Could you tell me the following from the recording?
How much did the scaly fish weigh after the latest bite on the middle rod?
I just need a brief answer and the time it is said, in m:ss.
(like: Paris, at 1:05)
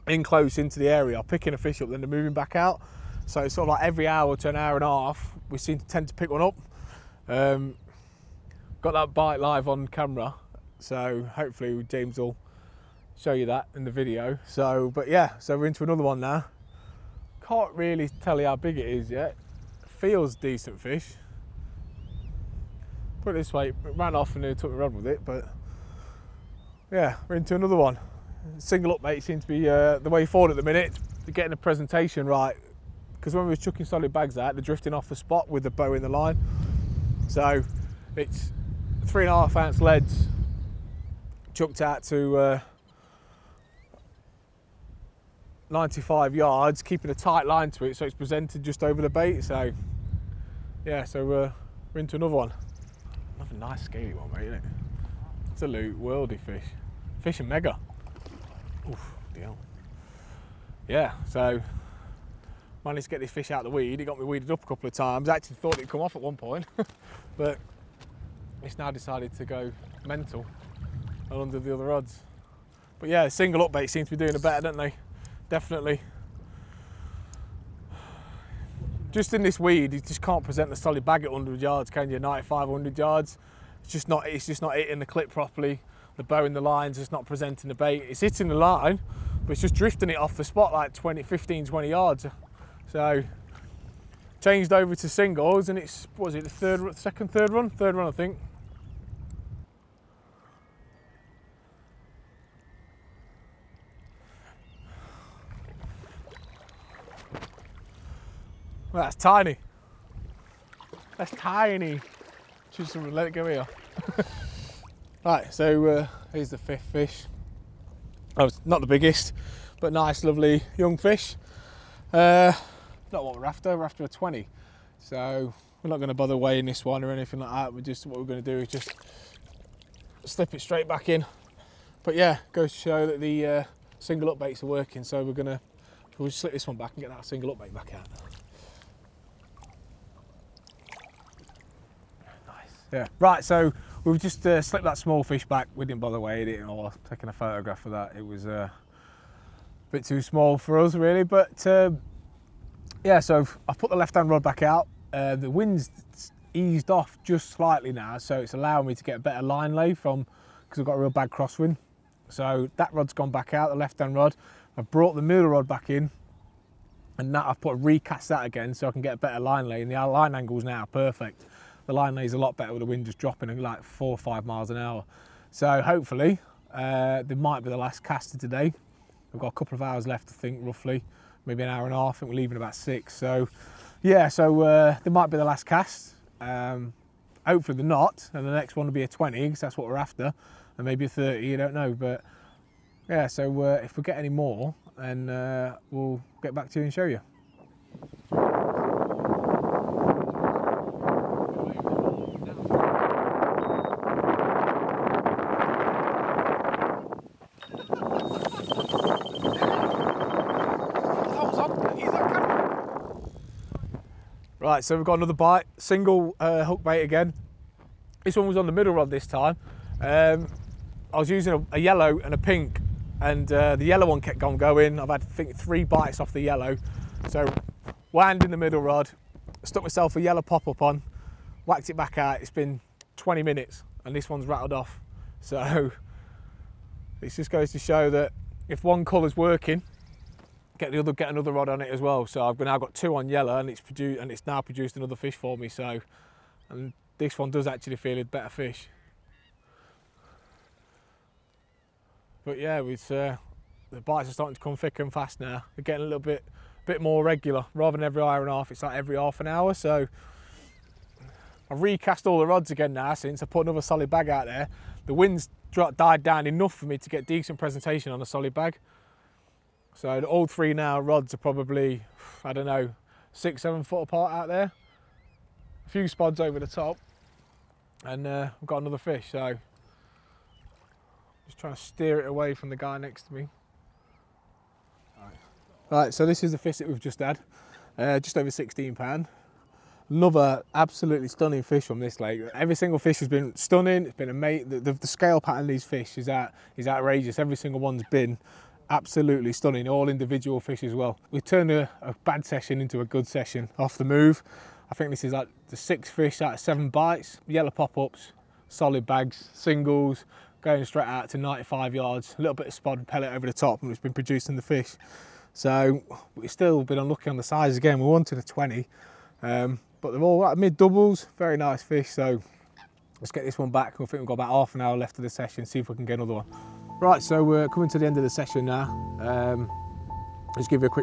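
Just over 16 pounds, at 4:48.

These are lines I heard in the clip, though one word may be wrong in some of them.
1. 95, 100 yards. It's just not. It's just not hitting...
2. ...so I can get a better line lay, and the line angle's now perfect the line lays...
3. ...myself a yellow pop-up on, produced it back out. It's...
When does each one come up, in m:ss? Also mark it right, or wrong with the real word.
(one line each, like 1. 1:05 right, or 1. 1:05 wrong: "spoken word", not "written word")
1. 1:22 right
2. 2:48 right
3. 3:49 wrong: "whacked", not "produced".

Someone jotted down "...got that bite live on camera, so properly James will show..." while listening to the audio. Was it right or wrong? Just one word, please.
wrong.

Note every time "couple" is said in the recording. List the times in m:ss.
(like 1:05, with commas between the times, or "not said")
1:04, 2:59.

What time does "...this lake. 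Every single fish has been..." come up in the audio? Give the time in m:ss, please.
4:51.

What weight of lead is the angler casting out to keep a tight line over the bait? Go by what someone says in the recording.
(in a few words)
3.5 ounces.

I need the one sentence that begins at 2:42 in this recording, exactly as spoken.
So that rod's gone back out, the left-hand rod.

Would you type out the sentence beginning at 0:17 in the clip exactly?
Can't really tell you how big it is yet.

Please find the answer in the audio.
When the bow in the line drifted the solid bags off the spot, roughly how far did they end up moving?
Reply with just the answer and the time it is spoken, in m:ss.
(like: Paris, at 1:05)
15-20 yards, at 1:31.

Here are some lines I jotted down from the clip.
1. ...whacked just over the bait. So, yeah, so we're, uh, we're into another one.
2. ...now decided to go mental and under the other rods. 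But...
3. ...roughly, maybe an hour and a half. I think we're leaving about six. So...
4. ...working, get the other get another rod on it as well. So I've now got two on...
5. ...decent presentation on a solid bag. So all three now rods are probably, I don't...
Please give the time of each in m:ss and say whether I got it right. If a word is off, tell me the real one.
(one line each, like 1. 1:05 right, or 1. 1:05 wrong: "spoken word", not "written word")
1. 0:48 wrong: "presented", not "whacked"
2. 1:08 right
3. 3:00 right
4. 3:59 right
5. 4:27 right.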